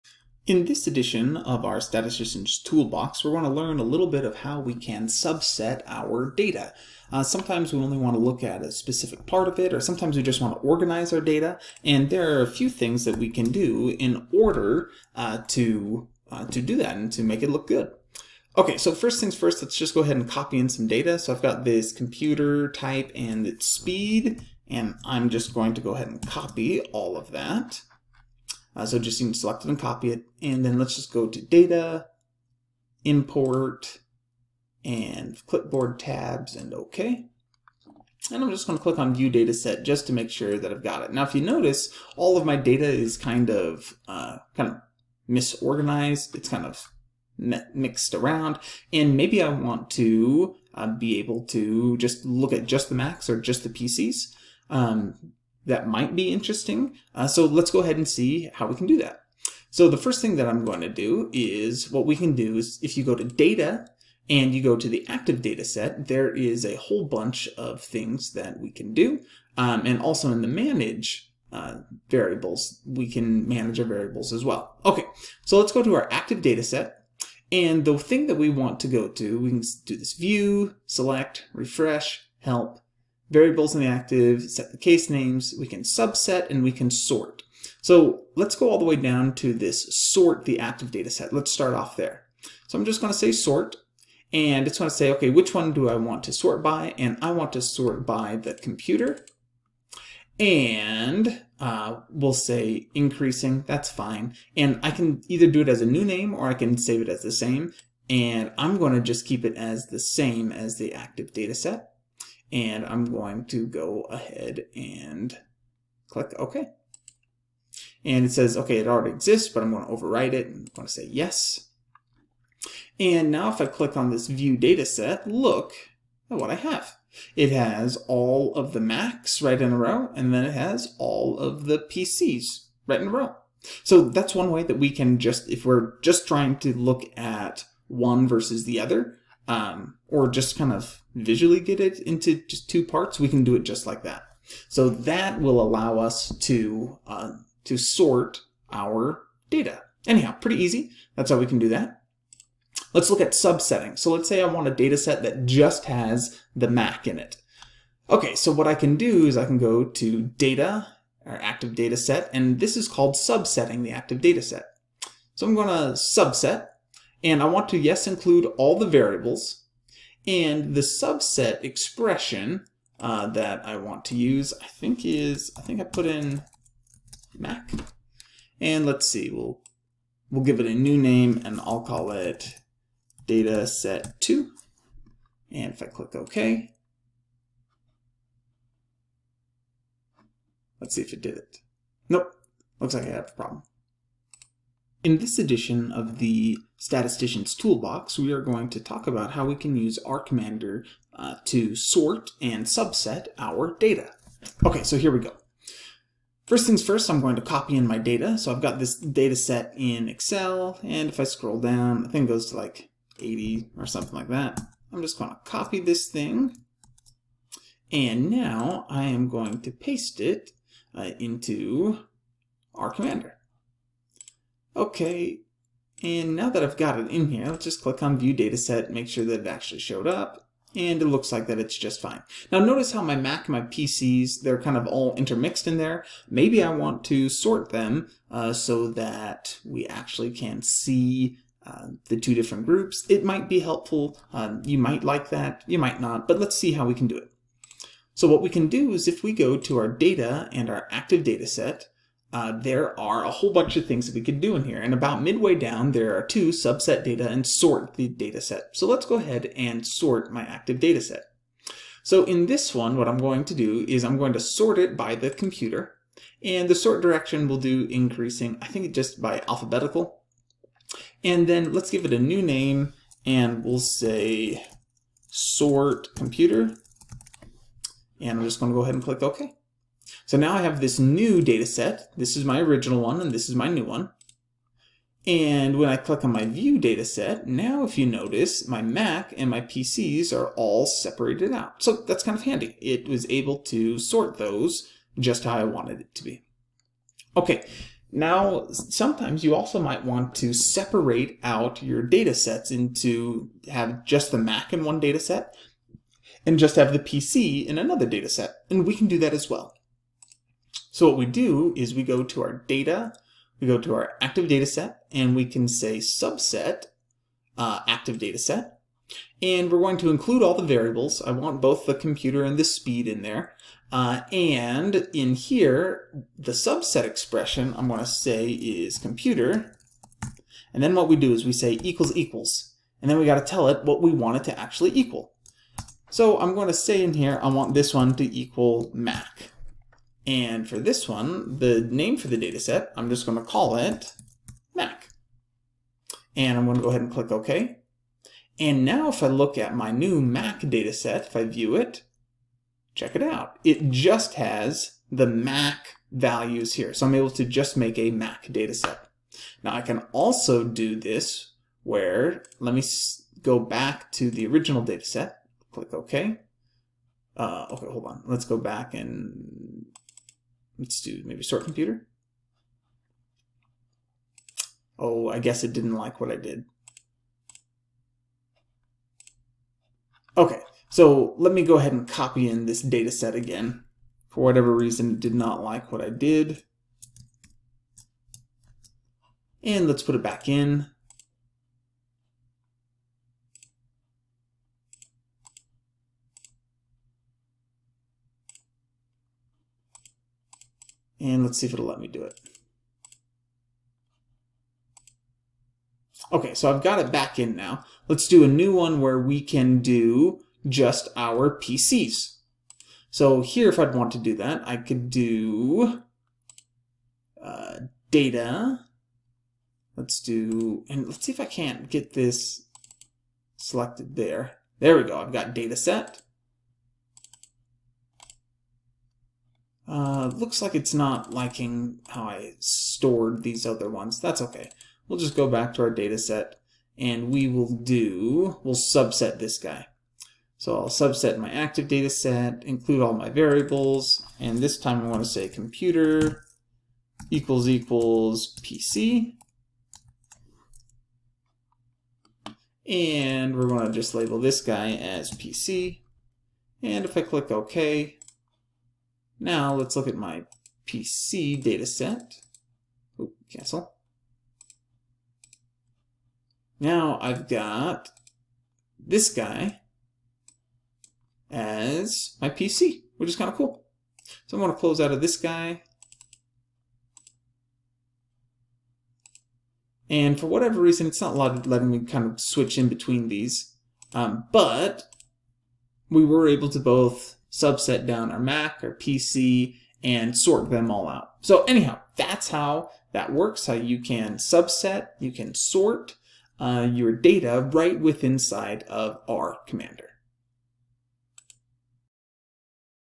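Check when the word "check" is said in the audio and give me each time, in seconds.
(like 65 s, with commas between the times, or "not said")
352 s.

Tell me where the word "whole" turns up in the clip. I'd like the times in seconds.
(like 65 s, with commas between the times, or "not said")
66 s, 253 s.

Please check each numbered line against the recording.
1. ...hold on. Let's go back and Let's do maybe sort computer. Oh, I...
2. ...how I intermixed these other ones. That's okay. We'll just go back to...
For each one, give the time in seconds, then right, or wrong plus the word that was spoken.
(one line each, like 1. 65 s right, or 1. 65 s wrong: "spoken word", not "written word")
1. 367 s right
2. 432 s wrong: "stored", not "intermixed".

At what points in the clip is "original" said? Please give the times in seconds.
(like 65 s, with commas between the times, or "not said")
282 s, 364 s.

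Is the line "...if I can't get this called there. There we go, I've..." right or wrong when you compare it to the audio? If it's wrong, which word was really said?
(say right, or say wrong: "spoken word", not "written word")
wrong: "selected", not "called".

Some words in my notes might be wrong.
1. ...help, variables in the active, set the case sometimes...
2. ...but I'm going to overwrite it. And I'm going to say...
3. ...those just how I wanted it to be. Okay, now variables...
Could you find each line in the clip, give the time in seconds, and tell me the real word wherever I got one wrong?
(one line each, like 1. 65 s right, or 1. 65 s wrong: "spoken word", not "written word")
1. 82 s wrong: "names", not "sometimes"
2. 119 s right
3. 294 s wrong: "sometimes", not "variables".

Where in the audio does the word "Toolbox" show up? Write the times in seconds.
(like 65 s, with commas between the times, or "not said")
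2 s, 197 s.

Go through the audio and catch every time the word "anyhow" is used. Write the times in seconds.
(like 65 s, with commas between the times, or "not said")
150 s, 491 s.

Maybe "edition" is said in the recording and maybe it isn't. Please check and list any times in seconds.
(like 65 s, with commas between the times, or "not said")
0 s, 195 s.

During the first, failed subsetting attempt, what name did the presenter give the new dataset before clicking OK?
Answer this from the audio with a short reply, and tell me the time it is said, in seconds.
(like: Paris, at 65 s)
data set 2, at 183 s.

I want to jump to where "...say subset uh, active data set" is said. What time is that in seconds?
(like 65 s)
315 s.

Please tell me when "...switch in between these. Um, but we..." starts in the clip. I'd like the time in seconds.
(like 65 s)
482 s.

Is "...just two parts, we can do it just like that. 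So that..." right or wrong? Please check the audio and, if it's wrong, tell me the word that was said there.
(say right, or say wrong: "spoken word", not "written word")
right.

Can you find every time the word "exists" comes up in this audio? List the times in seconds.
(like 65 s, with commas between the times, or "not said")
119 s.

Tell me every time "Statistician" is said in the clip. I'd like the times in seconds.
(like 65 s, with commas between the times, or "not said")
1 s, 196 s.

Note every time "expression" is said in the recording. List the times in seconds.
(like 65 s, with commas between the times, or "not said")
171 s, 327 s.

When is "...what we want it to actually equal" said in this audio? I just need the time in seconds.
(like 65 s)
333 s.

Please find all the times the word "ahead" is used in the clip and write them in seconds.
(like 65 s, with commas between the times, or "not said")
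20 s, 25 s, 57 s, 114 s, 259 s, 278 s, 346 s, 381 s.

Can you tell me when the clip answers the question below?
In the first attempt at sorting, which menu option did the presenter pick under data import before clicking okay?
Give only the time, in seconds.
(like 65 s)
35 s.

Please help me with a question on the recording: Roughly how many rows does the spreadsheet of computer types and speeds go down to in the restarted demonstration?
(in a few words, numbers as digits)
80.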